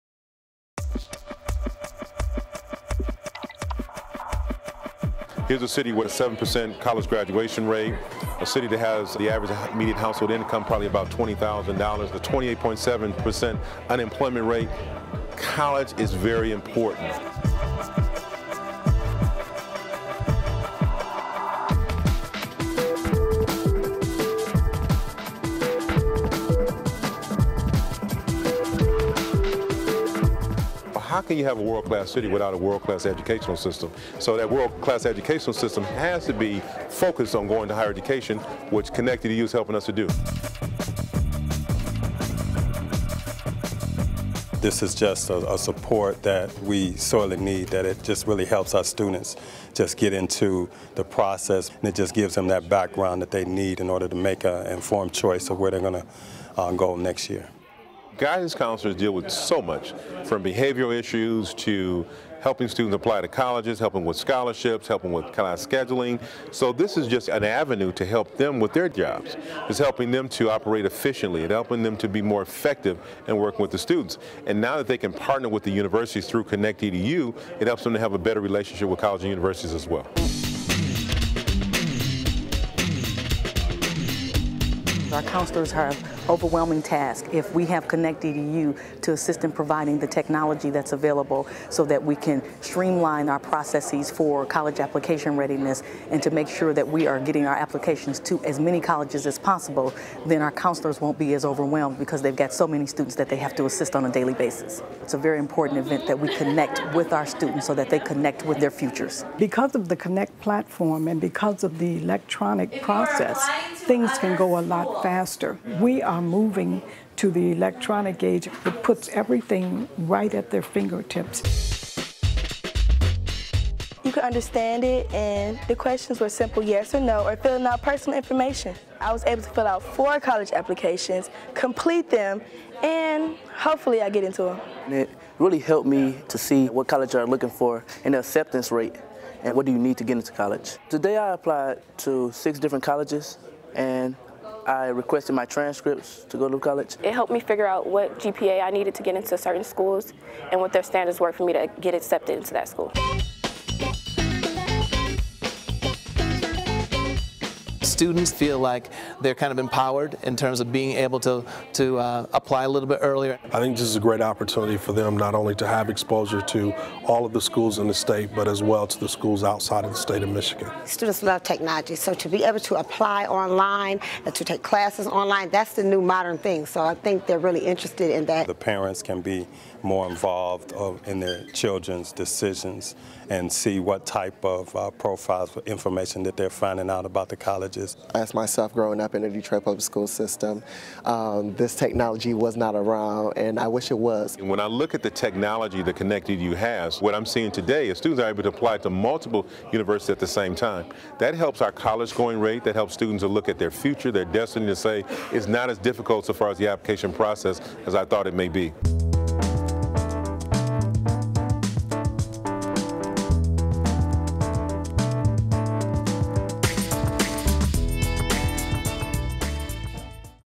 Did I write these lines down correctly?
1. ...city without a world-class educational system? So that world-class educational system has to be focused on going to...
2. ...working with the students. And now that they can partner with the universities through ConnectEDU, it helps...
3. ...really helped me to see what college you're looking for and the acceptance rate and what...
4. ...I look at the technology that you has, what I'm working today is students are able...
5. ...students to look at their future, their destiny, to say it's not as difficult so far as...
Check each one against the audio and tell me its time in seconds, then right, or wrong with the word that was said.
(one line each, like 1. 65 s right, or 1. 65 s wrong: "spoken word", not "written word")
1. 32 s right
2. 73 s right
3. 135 s right
4. 194 s wrong: "seeing", not "working"
5. 202 s right.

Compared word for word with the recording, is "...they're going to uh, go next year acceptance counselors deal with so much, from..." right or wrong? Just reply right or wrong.
wrong.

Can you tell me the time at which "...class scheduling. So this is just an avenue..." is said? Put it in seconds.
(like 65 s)
65 s.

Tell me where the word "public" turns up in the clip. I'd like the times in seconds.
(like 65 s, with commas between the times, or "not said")
189 s.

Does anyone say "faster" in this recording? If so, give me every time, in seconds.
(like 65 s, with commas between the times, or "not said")
115 s.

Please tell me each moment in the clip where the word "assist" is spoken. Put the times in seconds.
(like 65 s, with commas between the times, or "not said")
89 s, 103 s.